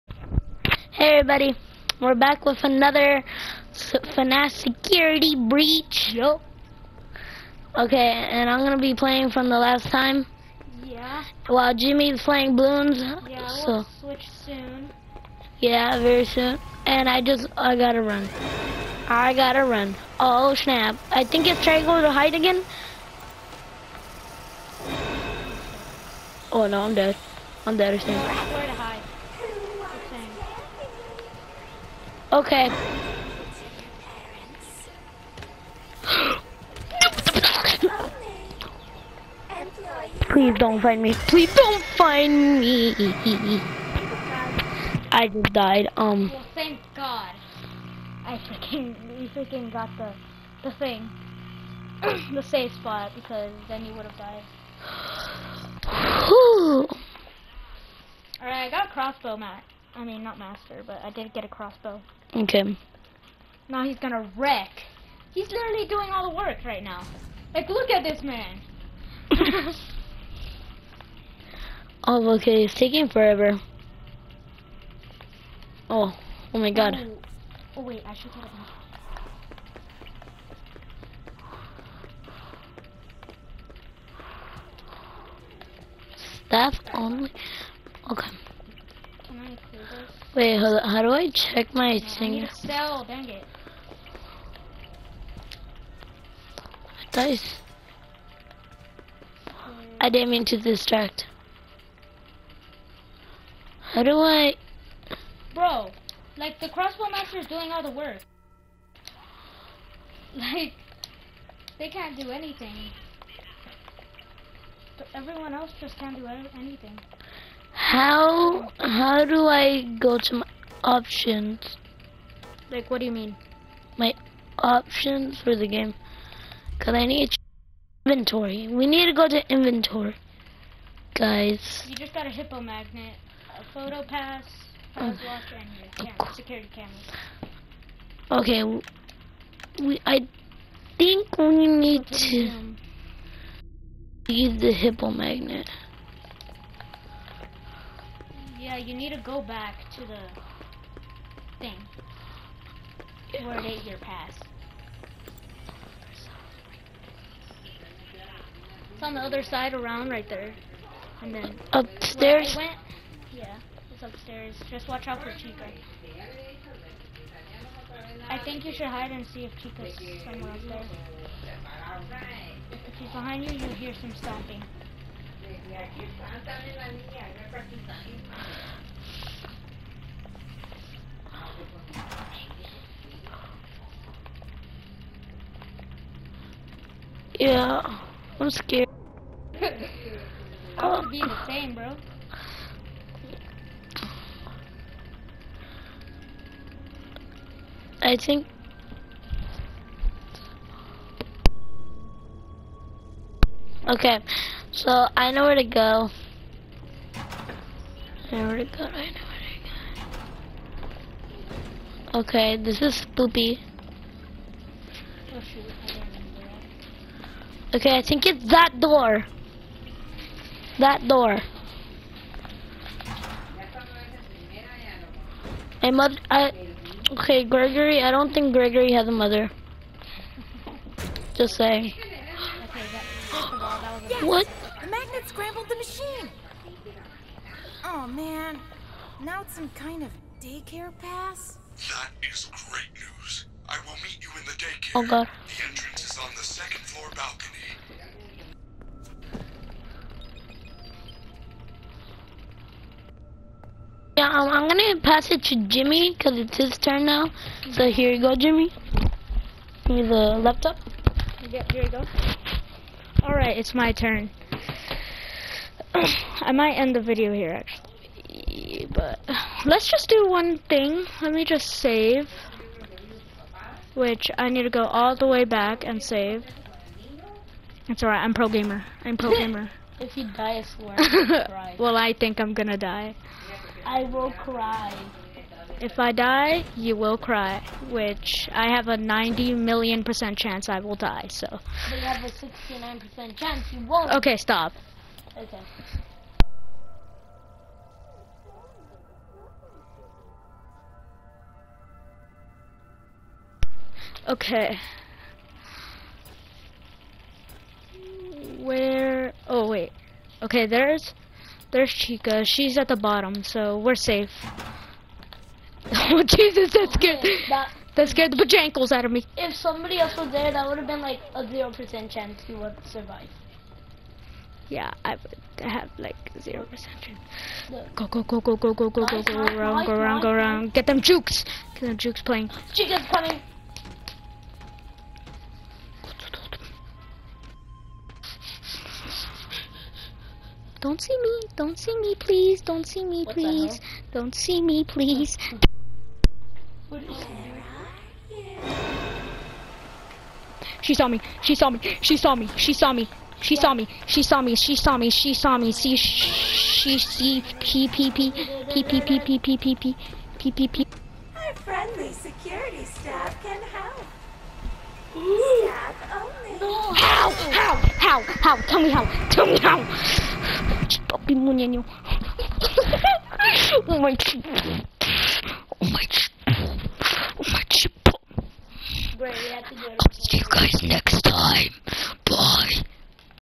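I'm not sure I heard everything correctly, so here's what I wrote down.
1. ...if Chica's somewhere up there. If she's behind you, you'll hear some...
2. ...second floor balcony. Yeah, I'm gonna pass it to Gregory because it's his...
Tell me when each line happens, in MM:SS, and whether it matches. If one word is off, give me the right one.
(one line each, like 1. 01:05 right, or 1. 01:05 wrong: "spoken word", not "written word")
1. 02:49 right
2. 04:06 wrong: "Jimmy", not "Gregory".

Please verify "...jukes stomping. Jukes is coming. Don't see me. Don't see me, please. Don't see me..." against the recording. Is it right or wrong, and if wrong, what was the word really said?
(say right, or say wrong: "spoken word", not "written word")
wrong: "playing", not "stomping".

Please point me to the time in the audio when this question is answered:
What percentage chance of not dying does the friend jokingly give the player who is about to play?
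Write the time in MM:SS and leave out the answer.
04:52.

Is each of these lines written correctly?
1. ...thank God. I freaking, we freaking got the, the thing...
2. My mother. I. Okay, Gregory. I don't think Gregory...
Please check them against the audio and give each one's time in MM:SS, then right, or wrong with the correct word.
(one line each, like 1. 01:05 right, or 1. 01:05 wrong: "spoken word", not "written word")
1. 00:46 right
2. 03:45 right.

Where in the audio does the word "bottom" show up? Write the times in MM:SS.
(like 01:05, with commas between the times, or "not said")
05:12.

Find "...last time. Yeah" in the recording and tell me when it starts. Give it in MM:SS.
00:09.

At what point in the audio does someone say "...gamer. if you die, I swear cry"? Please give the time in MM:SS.
04:39.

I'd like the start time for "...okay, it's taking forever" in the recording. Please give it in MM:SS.
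01:12.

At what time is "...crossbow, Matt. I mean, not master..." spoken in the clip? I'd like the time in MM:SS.
00:58.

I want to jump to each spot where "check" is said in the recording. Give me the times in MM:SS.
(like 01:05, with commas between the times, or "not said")
01:31.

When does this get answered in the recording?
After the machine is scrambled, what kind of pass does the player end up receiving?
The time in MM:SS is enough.
04:00.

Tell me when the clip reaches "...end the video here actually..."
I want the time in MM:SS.
04:26.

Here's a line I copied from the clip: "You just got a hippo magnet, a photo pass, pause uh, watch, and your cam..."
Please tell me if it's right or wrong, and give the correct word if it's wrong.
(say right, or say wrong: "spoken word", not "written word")
right.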